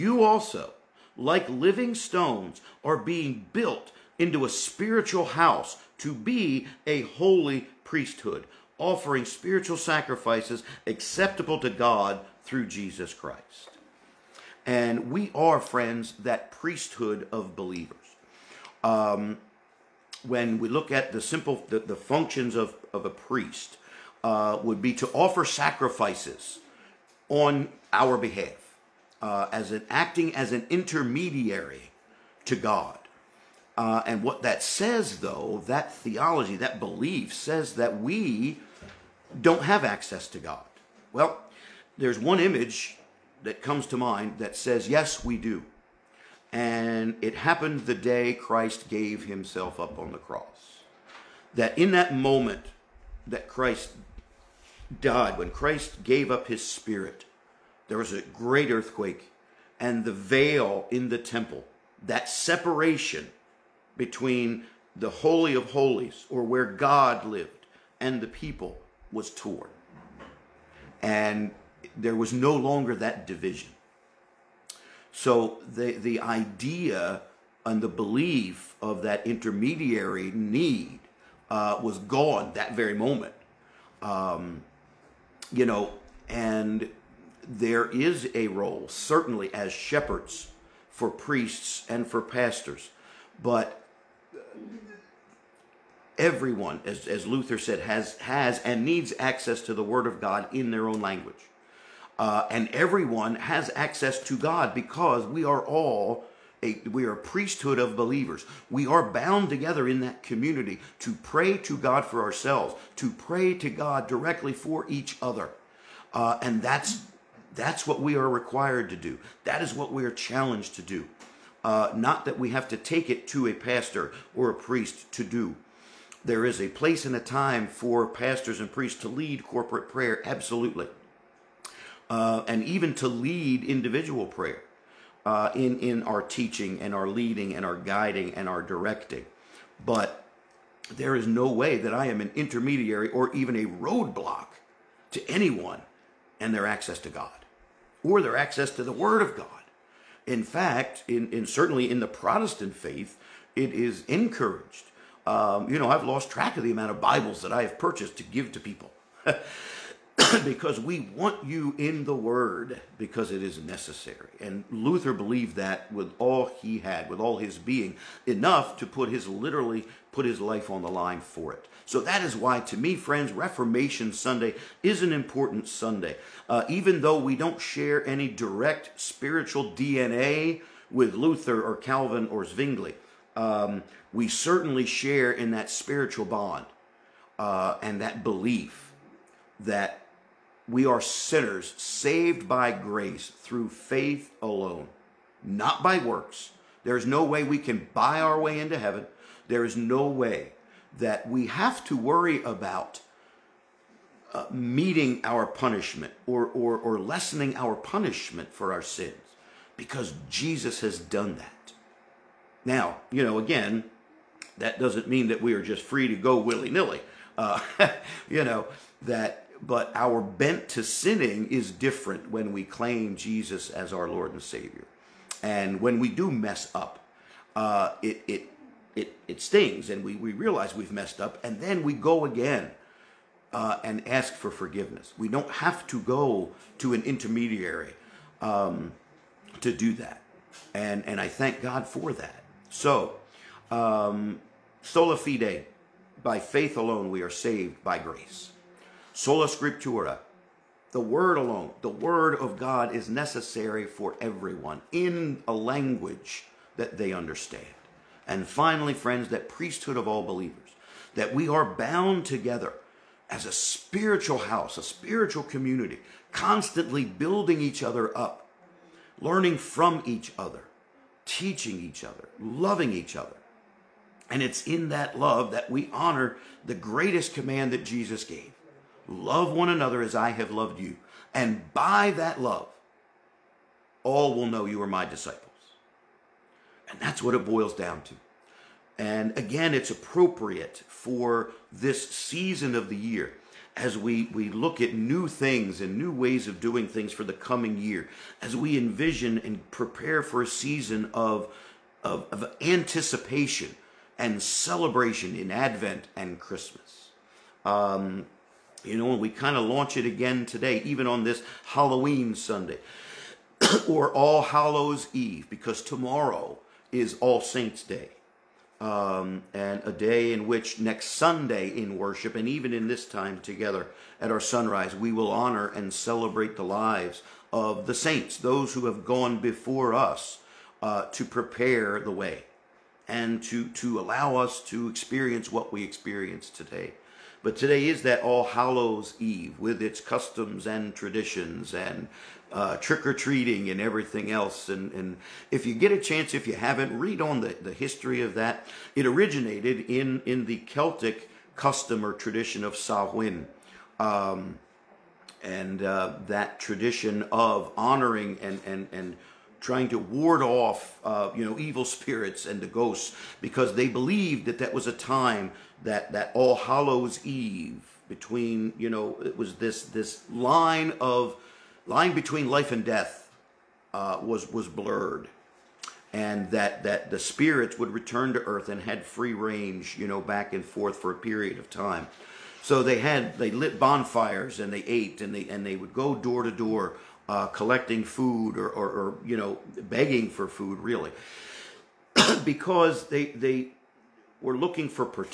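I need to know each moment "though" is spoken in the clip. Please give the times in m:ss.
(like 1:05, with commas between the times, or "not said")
0:35, 2:57.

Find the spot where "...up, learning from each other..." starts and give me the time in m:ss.
4:28.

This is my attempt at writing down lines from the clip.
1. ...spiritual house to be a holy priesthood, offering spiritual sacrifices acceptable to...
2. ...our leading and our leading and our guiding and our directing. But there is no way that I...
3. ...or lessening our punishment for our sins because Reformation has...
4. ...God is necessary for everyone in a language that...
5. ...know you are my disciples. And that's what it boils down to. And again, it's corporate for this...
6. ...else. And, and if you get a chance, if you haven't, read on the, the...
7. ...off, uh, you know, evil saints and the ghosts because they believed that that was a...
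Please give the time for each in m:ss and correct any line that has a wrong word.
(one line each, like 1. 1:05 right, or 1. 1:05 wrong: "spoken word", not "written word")
1. 0:04 right
2. 2:16 wrong: "teaching", not "leading"
3. 3:26 wrong: "Jesus", not "Reformation"
4. 4:12 right
5. 4:44 wrong: "appropriate", not "corporate"
6. 5:44 right
7. 6:00 wrong: "spirits", not "saints".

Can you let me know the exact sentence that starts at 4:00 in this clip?
And, and I thank God for that.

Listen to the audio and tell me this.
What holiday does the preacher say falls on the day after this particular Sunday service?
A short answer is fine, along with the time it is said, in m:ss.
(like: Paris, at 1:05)
All Saints Day, at 5:17.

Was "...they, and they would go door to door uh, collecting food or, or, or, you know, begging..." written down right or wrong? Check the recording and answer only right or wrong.
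right.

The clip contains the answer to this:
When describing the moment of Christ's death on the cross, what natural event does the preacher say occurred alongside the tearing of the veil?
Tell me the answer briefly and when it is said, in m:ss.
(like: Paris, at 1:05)
a great earthquake, at 0:58.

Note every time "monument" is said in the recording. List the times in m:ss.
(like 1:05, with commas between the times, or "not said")
not said.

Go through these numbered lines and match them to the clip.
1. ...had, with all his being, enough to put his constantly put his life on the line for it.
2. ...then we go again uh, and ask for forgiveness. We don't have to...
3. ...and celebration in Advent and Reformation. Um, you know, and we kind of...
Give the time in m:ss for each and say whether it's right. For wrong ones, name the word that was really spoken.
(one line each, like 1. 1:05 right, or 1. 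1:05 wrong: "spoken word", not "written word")
1. 2:46 wrong: "literally", not "constantly"
2. 3:51 right
3. 5:04 wrong: "Christmas", not "Reformation".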